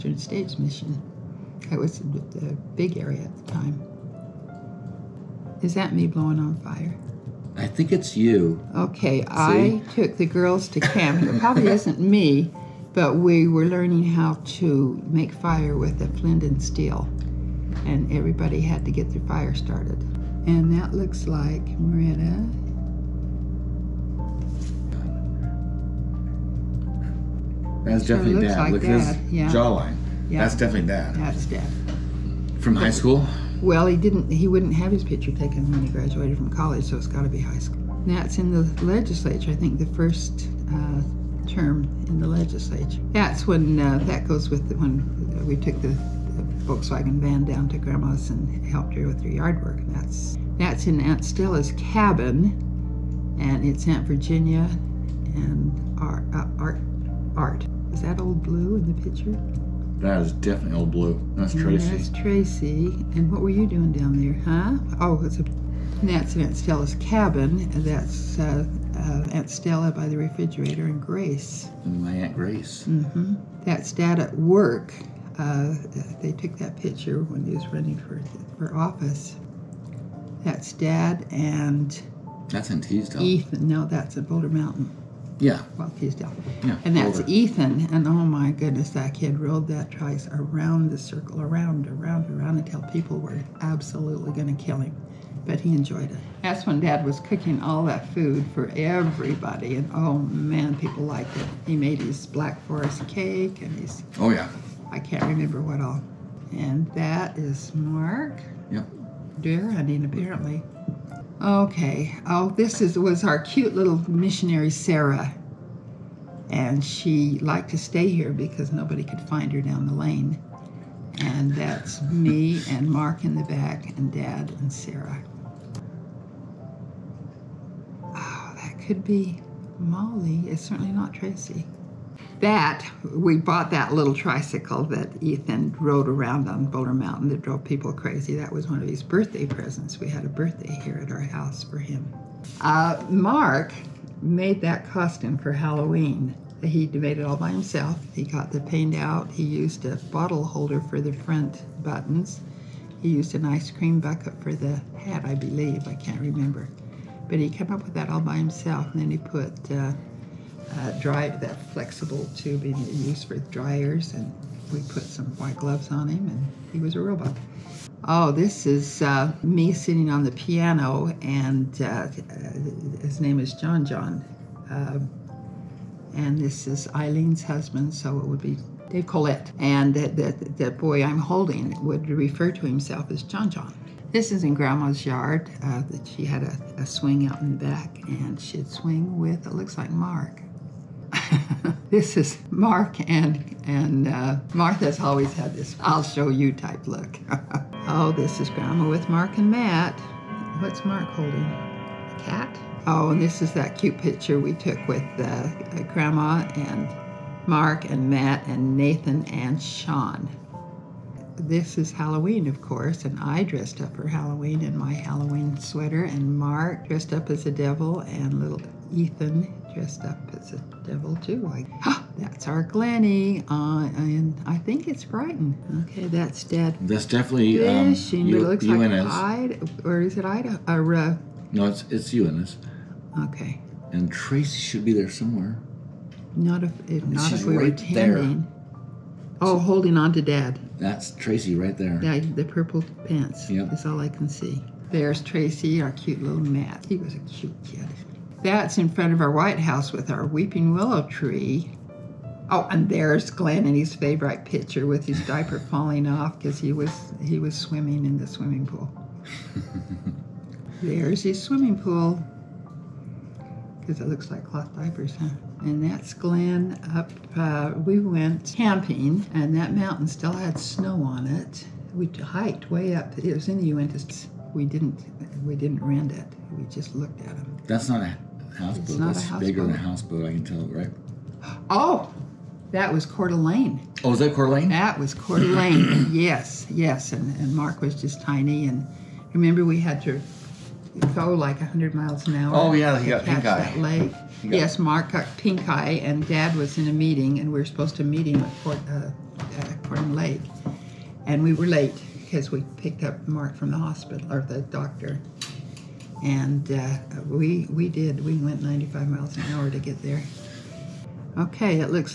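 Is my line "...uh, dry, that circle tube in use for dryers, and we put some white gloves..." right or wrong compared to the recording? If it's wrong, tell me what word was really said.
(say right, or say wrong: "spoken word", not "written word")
wrong: "flexible", not "circle".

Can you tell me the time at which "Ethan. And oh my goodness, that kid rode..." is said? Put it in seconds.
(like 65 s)
87 s.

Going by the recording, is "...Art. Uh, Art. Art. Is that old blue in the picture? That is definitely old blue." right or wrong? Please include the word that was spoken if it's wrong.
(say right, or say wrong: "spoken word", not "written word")
right.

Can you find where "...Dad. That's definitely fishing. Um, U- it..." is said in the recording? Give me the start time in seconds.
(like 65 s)
226 s.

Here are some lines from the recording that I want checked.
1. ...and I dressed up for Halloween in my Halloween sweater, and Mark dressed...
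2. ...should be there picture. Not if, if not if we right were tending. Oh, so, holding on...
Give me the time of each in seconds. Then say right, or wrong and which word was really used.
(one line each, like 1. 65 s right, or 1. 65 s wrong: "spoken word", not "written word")
1. 213 s right
2. 234 s wrong: "somewhere", not "picture".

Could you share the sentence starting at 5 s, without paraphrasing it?
Is that me blowing on fire?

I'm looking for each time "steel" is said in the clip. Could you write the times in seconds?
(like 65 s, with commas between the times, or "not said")
16 s.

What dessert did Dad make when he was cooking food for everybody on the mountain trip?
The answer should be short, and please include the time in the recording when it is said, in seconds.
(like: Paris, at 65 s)
Black Forest cake, at 102 s.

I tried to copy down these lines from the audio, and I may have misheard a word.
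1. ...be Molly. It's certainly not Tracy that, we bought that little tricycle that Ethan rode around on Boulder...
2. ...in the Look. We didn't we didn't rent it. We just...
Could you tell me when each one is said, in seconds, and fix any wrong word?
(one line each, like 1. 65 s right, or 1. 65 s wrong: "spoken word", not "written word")
1. 129 s right
2. 273 s wrong: "Uintas", not "Look".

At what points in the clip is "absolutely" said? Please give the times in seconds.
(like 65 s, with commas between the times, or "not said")
93 s.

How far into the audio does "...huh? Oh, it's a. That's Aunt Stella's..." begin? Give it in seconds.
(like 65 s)
64 s.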